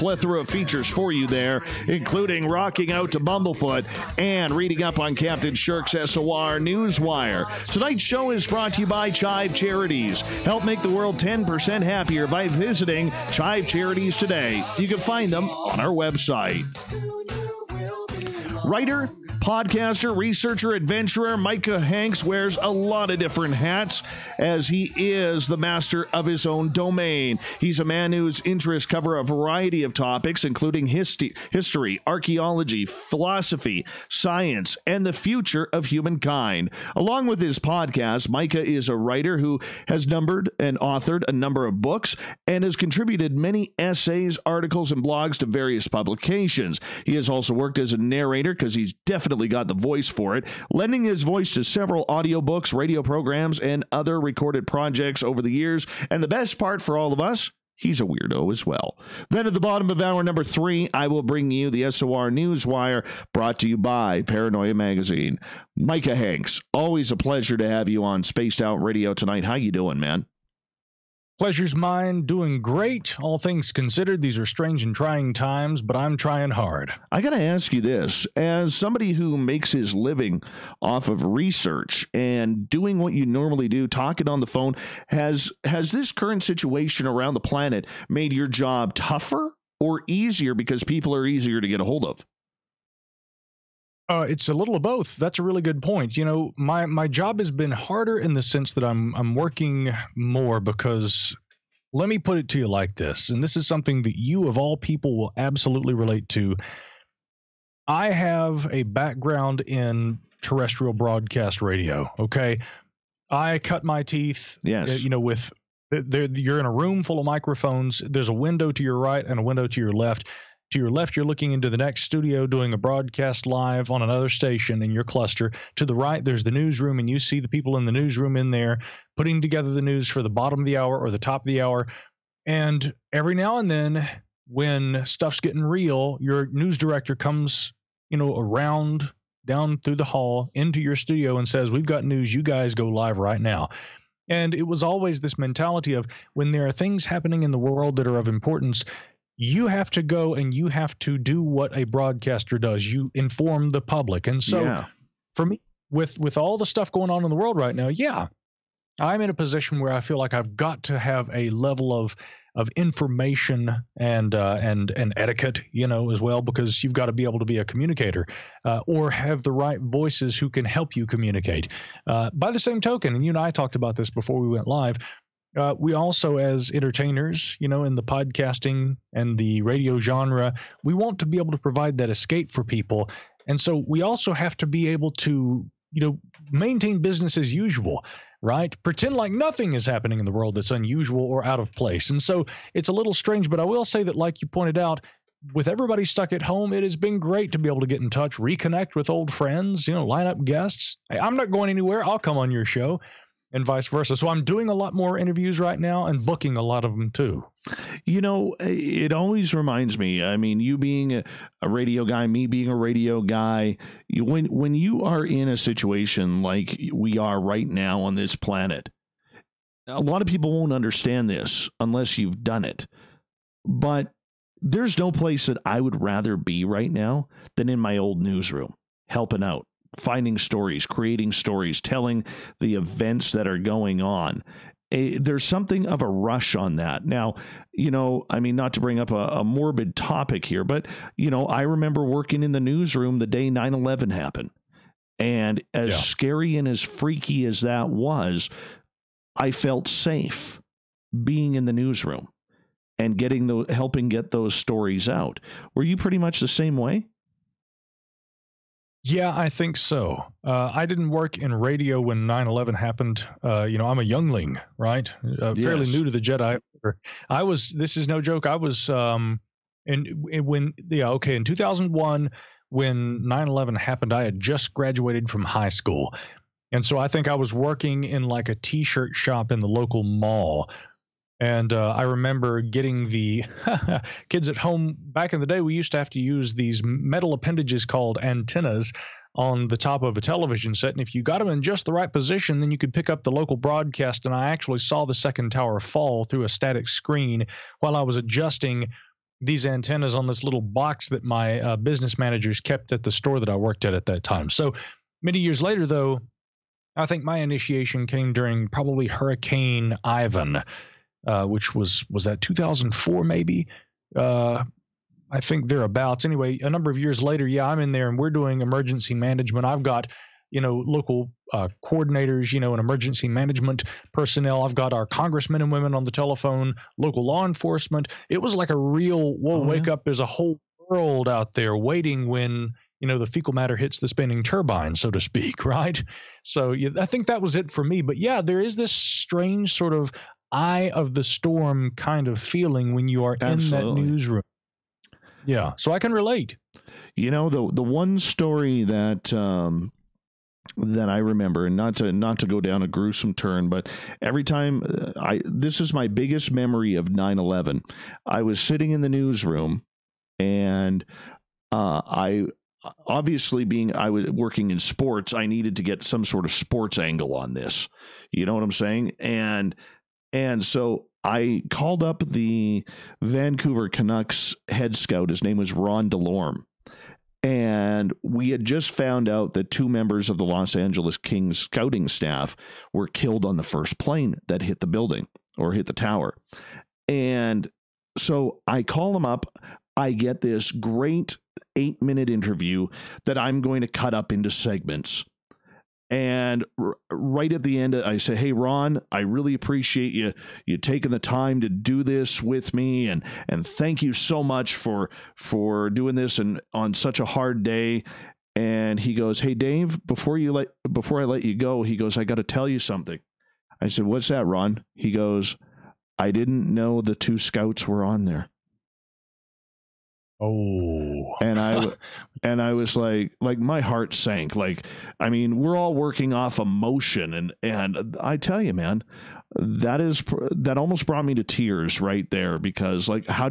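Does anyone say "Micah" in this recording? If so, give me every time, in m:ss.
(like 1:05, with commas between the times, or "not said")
0:21, 0:38, 1:05.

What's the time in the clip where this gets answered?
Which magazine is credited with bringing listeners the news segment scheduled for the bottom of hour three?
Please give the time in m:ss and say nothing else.
1:04.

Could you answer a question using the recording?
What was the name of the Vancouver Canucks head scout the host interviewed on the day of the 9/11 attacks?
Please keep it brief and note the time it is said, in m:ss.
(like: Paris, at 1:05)
Ron DeLorme, at 6:15.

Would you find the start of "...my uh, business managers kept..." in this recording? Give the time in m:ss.
5:01.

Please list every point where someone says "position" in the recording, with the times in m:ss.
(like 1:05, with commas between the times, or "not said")
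2:39, 4:52.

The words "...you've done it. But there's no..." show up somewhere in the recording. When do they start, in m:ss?
3:42.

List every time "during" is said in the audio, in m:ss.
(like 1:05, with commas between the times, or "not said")
5:08.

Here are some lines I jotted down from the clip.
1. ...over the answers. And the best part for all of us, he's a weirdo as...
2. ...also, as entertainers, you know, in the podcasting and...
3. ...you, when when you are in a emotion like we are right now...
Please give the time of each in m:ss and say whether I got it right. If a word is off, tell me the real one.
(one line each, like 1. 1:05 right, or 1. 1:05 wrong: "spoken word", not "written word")
1. 0:55 wrong: "years", not "answers"
2. 2:55 right
3. 3:34 wrong: "situation", not "emotion".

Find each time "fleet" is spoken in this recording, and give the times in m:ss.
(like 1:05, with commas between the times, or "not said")
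not said.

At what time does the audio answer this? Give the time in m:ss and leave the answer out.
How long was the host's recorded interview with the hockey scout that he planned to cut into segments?
6:31.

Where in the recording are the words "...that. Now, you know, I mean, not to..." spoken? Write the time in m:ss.
3:56.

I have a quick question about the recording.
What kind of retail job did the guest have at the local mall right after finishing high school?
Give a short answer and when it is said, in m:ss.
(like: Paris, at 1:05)
t shirt shop, at 4:38.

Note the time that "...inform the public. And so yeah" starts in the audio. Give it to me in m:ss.
2:33.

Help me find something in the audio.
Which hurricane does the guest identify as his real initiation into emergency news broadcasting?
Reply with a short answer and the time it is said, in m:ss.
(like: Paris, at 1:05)
Hurricane Ivan, at 5:09.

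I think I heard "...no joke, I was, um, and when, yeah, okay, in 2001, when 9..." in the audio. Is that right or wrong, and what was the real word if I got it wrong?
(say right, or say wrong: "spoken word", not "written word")
right.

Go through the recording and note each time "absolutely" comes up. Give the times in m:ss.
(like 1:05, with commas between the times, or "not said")
1:45, 5:43.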